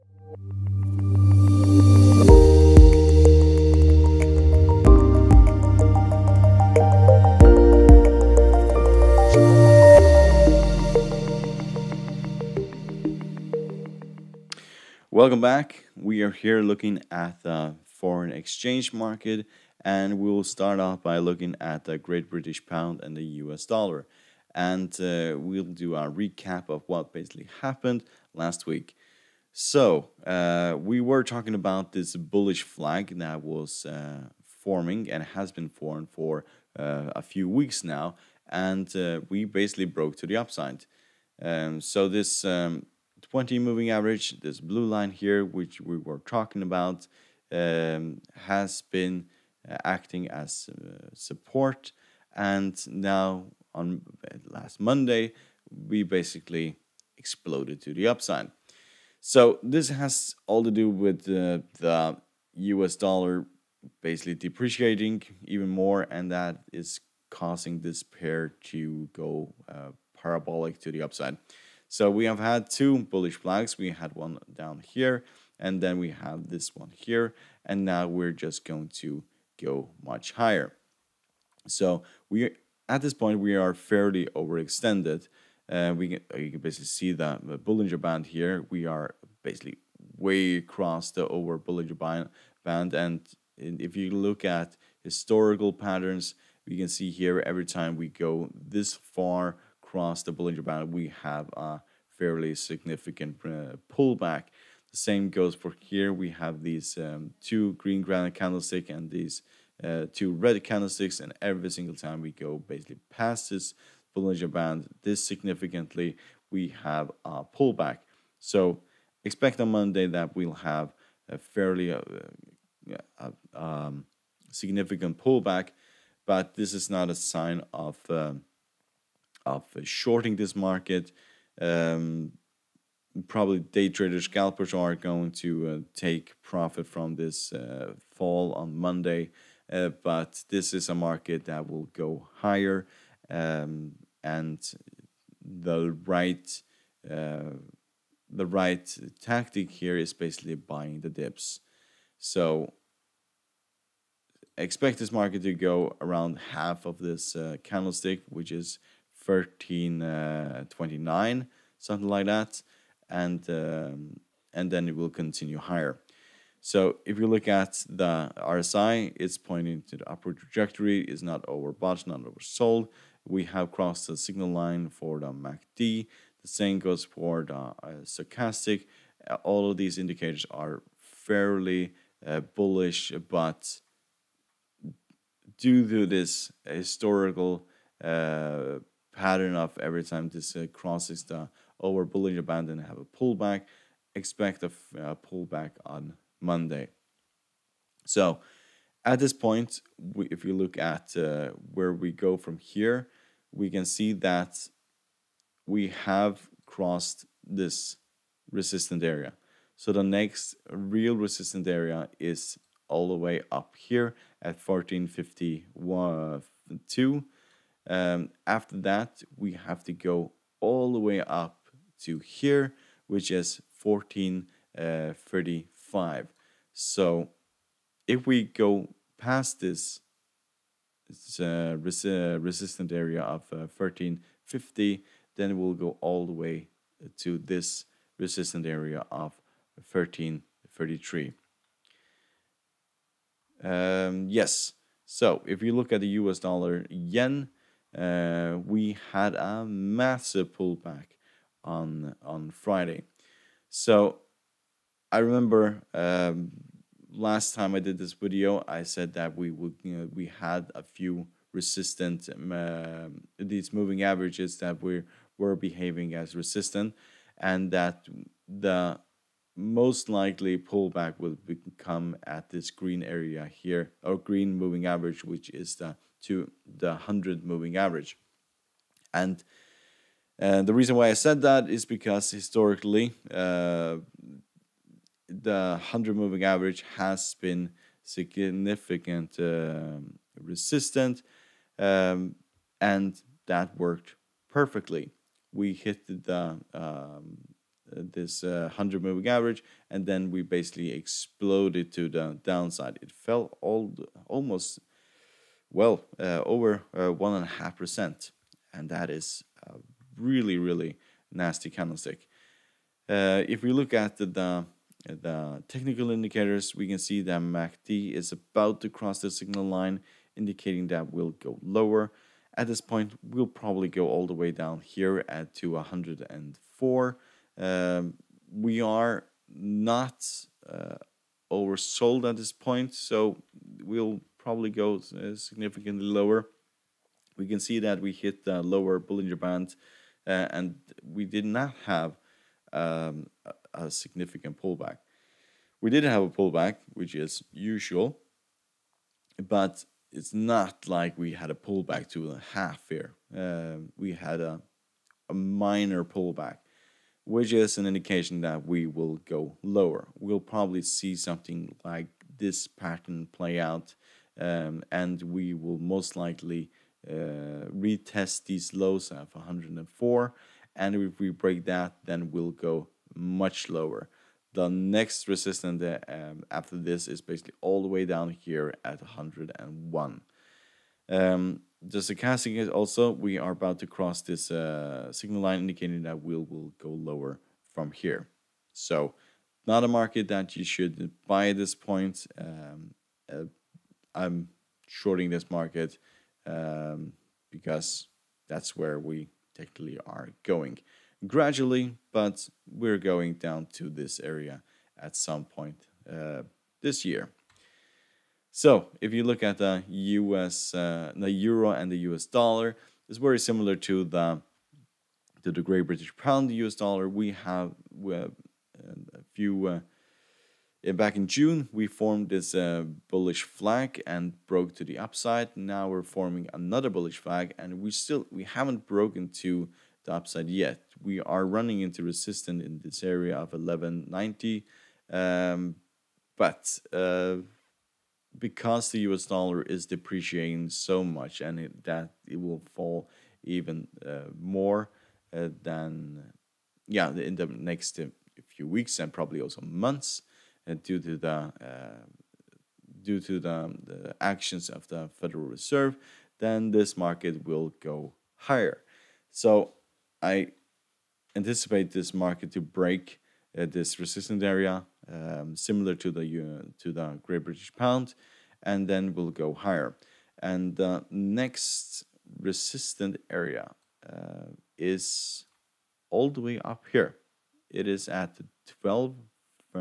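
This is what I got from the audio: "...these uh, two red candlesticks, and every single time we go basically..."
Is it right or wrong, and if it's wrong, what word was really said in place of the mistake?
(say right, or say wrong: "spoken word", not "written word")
right.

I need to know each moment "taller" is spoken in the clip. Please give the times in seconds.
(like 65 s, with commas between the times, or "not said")
not said.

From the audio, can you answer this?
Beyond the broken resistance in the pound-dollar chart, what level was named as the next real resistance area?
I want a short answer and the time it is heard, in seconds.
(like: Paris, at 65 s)
1452, at 214 s.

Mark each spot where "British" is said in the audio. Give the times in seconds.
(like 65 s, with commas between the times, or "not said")
22 s, 415 s, 467 s.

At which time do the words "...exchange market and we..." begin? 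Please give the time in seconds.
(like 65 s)
18 s.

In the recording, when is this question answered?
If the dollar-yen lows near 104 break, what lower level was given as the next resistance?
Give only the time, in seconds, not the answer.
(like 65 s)
379 s.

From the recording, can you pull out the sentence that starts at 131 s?
Um, probably day traders, scalpers are going to uh, take profit from this uh, fall on Monday.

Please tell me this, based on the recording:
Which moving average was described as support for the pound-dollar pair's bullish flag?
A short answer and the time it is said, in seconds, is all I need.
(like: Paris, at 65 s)
20 moving average, at 43 s.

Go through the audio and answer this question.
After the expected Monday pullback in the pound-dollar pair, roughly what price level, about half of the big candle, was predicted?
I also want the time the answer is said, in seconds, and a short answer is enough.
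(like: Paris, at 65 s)
1329, at 159 s.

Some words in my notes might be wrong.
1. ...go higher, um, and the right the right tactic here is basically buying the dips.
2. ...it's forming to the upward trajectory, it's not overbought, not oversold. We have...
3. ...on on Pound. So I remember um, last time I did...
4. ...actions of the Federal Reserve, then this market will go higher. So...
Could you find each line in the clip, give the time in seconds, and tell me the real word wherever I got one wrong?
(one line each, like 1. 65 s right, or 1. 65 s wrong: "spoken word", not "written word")
1. 141 s right
2. 169 s wrong: "pointing", not "forming"
3. 251 s wrong: "Friday", not "Pound"
4. 454 s right.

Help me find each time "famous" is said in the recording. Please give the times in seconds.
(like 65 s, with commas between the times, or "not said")
not said.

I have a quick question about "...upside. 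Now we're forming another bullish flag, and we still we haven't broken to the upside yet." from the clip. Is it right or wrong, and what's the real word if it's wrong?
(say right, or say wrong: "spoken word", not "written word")
right.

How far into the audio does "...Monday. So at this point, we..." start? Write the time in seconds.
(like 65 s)
196 s.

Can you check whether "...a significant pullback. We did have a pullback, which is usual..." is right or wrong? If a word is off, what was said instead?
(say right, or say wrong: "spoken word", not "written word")
right.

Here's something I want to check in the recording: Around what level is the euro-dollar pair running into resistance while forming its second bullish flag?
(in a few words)
1190.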